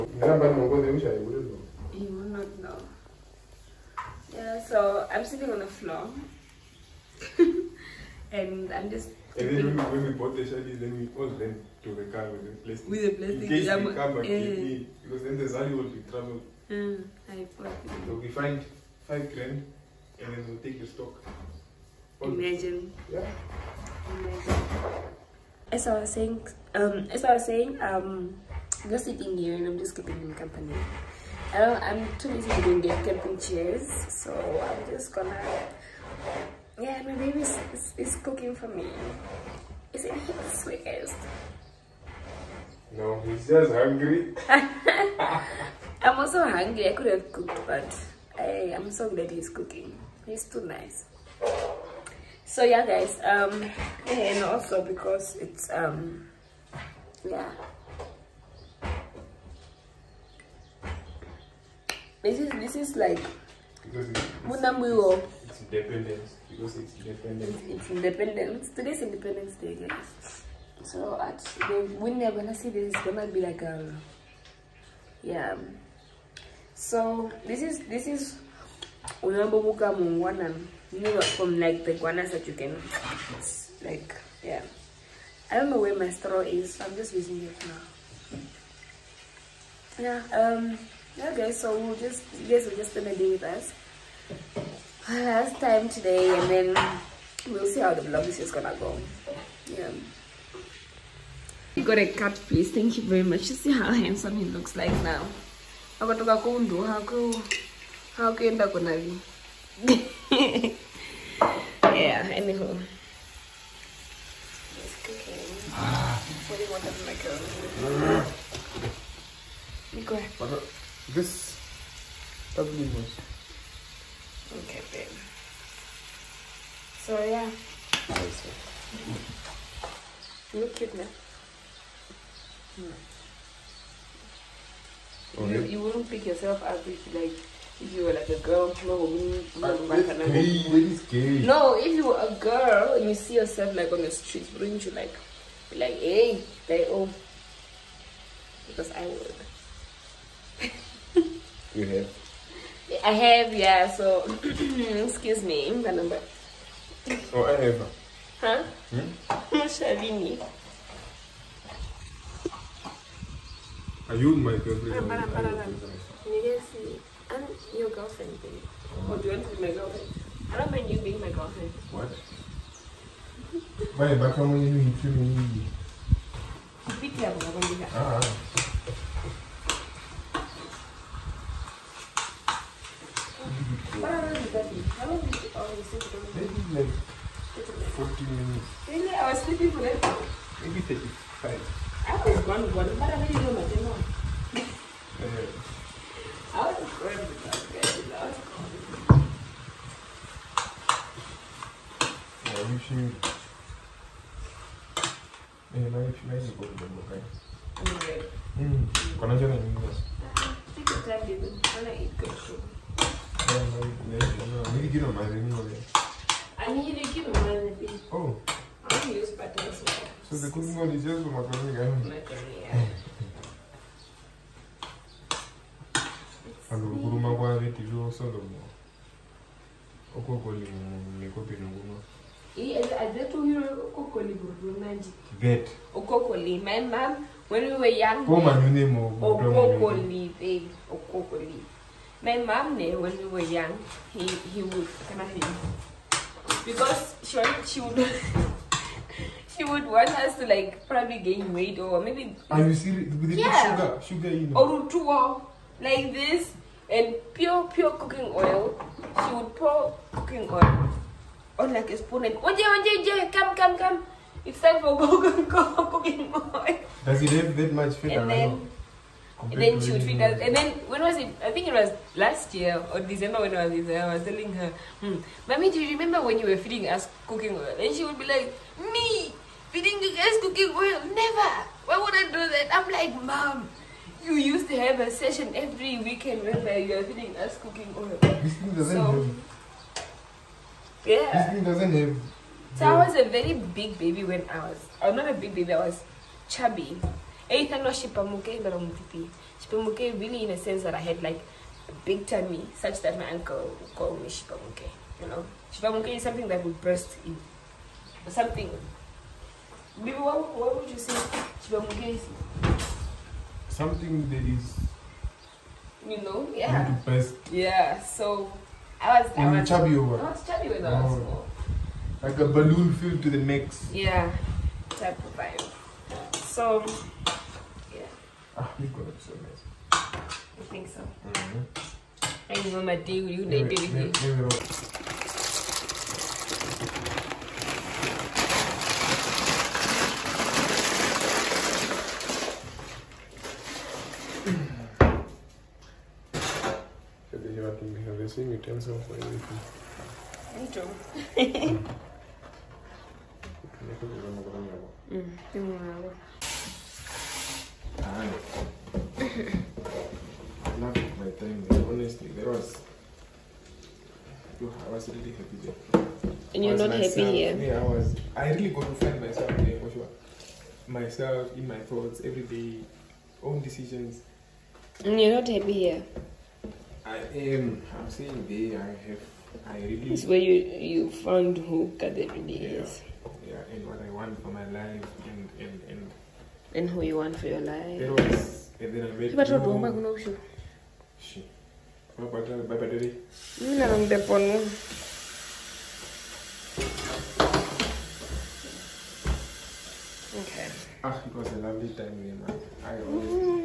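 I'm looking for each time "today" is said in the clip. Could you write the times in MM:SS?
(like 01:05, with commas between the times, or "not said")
01:08, 01:35.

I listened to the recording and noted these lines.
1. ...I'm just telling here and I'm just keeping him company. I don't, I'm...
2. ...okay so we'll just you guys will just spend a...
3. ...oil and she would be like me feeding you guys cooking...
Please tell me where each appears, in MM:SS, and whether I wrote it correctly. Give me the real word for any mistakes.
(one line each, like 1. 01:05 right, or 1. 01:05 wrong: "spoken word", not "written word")
1. 00:28 wrong: "sitting", not "telling"
2. 01:31 right
3. 04:37 right.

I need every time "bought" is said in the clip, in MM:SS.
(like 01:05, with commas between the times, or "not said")
00:10.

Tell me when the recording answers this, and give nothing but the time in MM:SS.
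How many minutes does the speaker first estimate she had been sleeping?
03:07.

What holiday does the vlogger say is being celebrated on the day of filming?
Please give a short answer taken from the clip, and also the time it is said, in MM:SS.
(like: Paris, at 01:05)
Independence Day, at 01:09.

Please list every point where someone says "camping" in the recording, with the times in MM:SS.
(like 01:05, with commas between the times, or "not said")
00:33.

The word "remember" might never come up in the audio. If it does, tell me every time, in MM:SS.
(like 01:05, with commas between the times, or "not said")
04:35, 05:32.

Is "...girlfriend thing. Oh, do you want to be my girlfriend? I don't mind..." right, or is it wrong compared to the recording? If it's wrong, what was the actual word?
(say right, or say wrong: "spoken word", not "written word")
right.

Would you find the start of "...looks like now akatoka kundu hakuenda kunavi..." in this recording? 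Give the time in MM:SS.
01:44.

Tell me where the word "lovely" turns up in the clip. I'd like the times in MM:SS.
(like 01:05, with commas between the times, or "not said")
06:41.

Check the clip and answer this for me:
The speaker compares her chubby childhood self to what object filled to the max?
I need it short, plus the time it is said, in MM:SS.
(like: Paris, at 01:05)
a balloon, at 05:22.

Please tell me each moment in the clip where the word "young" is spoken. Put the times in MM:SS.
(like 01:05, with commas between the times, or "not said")
03:58, 04:03.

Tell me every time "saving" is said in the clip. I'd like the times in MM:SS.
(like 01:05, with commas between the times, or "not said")
not said.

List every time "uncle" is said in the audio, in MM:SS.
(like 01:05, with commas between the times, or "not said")
05:03.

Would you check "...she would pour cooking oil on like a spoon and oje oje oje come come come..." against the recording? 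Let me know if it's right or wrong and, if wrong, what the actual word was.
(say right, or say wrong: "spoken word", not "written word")
right.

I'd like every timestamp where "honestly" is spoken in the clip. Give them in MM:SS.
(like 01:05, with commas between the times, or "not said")
06:01.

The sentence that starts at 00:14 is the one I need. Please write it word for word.
me, because then the shelly will be traveled.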